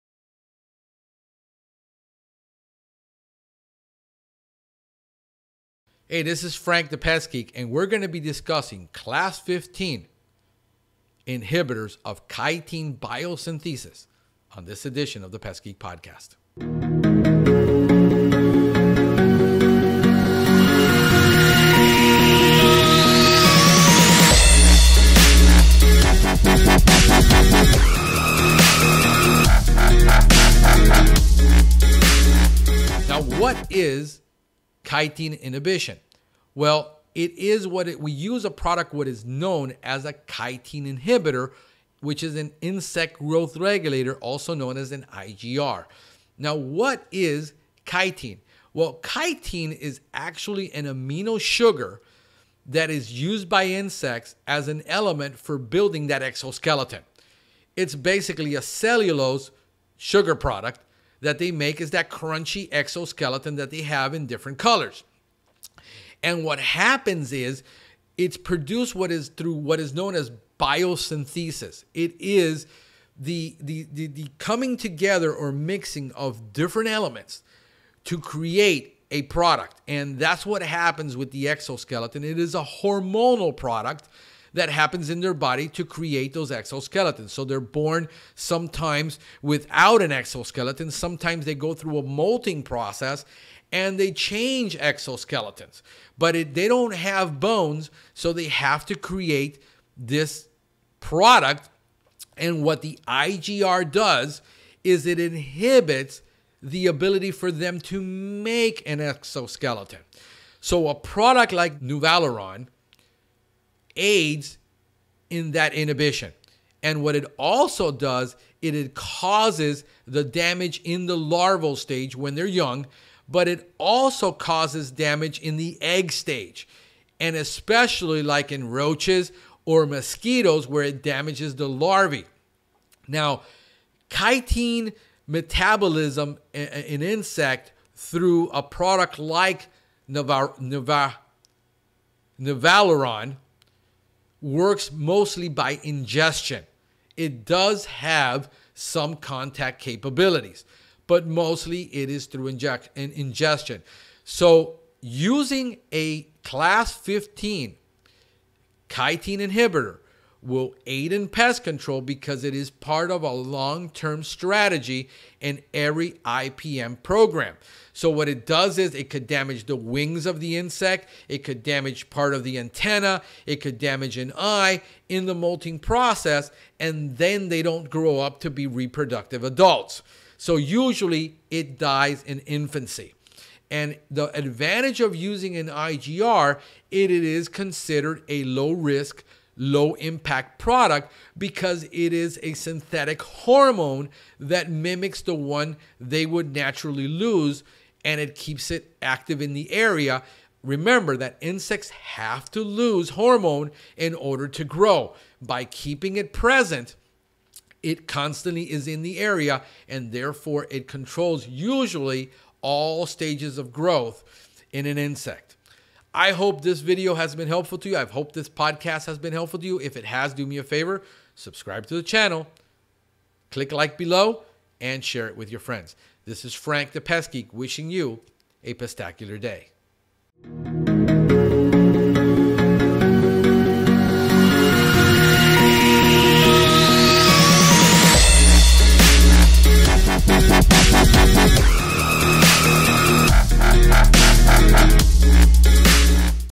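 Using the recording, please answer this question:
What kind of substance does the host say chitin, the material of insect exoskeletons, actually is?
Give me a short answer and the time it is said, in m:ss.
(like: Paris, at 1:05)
amino sugar, at 0:50.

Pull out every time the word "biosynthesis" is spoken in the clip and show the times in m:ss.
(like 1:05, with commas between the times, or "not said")
0:12, 1:10.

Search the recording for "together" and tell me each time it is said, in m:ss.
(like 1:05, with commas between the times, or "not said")
1:14.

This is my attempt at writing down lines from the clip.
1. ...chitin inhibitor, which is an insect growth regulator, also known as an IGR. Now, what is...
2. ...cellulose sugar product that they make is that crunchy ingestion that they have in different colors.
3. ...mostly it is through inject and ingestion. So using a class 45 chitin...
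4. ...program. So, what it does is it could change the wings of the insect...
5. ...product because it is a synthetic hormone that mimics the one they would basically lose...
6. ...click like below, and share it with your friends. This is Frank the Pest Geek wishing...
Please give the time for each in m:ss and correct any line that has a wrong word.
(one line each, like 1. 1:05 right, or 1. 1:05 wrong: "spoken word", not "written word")
1. 0:40 right
2. 0:58 wrong: "exoskeleton", not "ingestion"
3. 2:31 wrong: "15", not "45"
4. 2:47 wrong: "damage", not "change"
5. 3:10 wrong: "naturally", not "basically"
6. 3:43 right.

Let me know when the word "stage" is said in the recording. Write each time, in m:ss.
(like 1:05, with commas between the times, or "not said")
2:01, 2:06, 3:33.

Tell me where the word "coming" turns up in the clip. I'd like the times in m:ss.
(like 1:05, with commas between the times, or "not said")
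1:14.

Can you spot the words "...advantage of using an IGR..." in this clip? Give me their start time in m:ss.
3:04.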